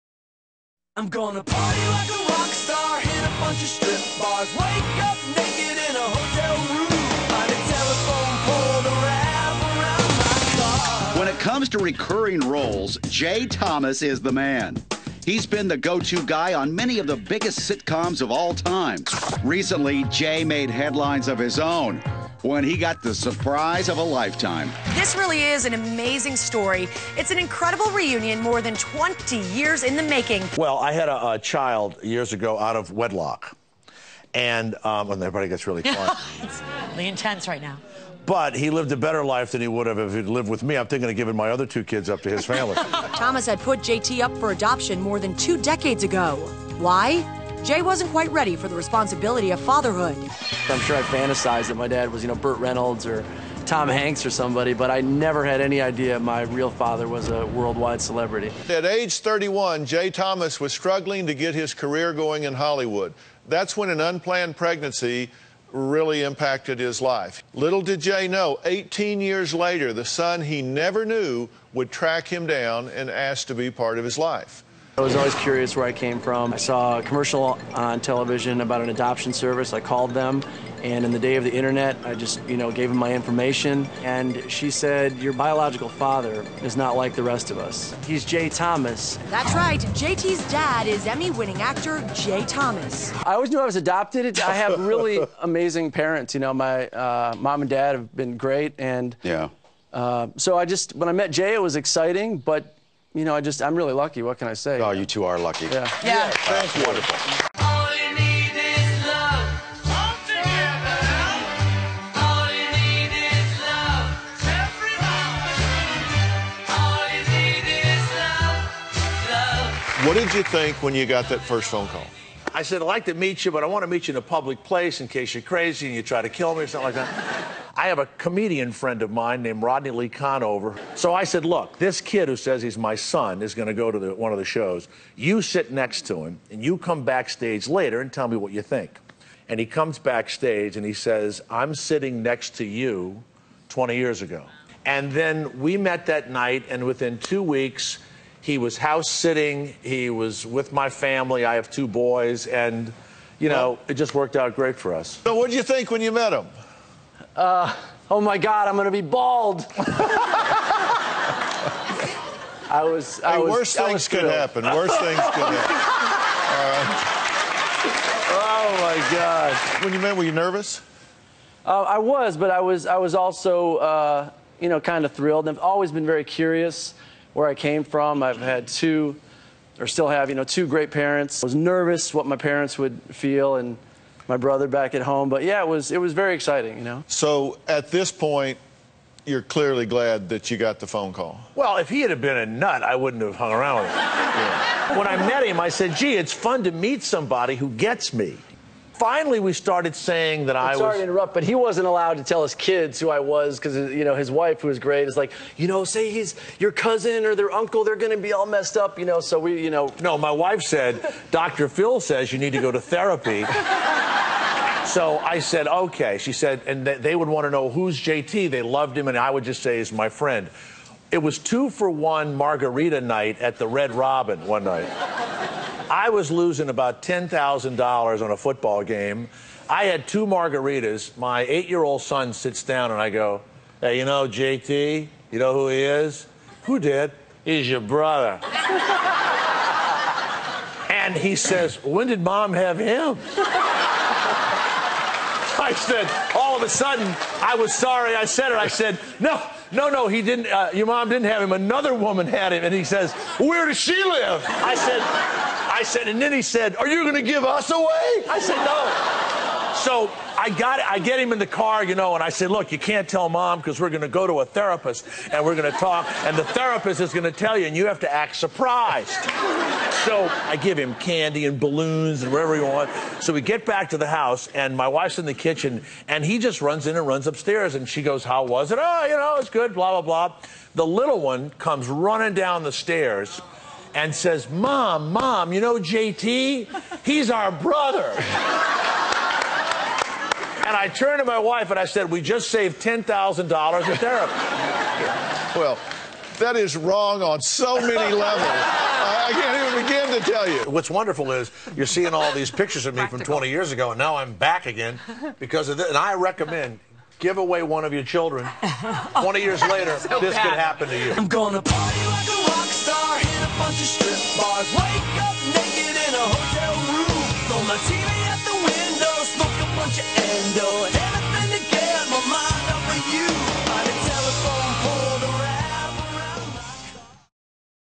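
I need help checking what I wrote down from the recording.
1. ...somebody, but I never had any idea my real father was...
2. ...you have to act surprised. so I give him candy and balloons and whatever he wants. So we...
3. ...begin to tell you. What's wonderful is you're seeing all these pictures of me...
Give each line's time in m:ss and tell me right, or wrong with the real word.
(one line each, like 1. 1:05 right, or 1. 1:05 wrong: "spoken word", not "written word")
1. 0:54 right
2. 4:27 right
3. 4:59 right.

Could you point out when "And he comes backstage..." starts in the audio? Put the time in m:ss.
2:19.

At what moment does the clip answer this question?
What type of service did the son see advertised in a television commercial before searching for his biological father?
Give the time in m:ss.
1:18.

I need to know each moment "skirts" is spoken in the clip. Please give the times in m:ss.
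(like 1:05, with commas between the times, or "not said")
not said.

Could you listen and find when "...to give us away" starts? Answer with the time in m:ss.
4:17.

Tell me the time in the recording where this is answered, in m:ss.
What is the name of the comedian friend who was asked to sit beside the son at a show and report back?
2:09.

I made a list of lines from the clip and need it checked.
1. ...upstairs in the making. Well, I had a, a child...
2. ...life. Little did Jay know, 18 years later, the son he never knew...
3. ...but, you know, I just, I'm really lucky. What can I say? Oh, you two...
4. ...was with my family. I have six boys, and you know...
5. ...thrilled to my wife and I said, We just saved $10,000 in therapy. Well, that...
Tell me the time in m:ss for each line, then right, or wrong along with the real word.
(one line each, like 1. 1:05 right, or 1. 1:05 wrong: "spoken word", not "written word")
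1. 0:29 wrong: "years", not "upstairs"
2. 1:07 right
3. 1:42 right
4. 2:30 wrong: "two", not "six"
5. 4:50 wrong: "turned", not "thrilled".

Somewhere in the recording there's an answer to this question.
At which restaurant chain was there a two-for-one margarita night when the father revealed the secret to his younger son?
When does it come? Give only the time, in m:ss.
3:43.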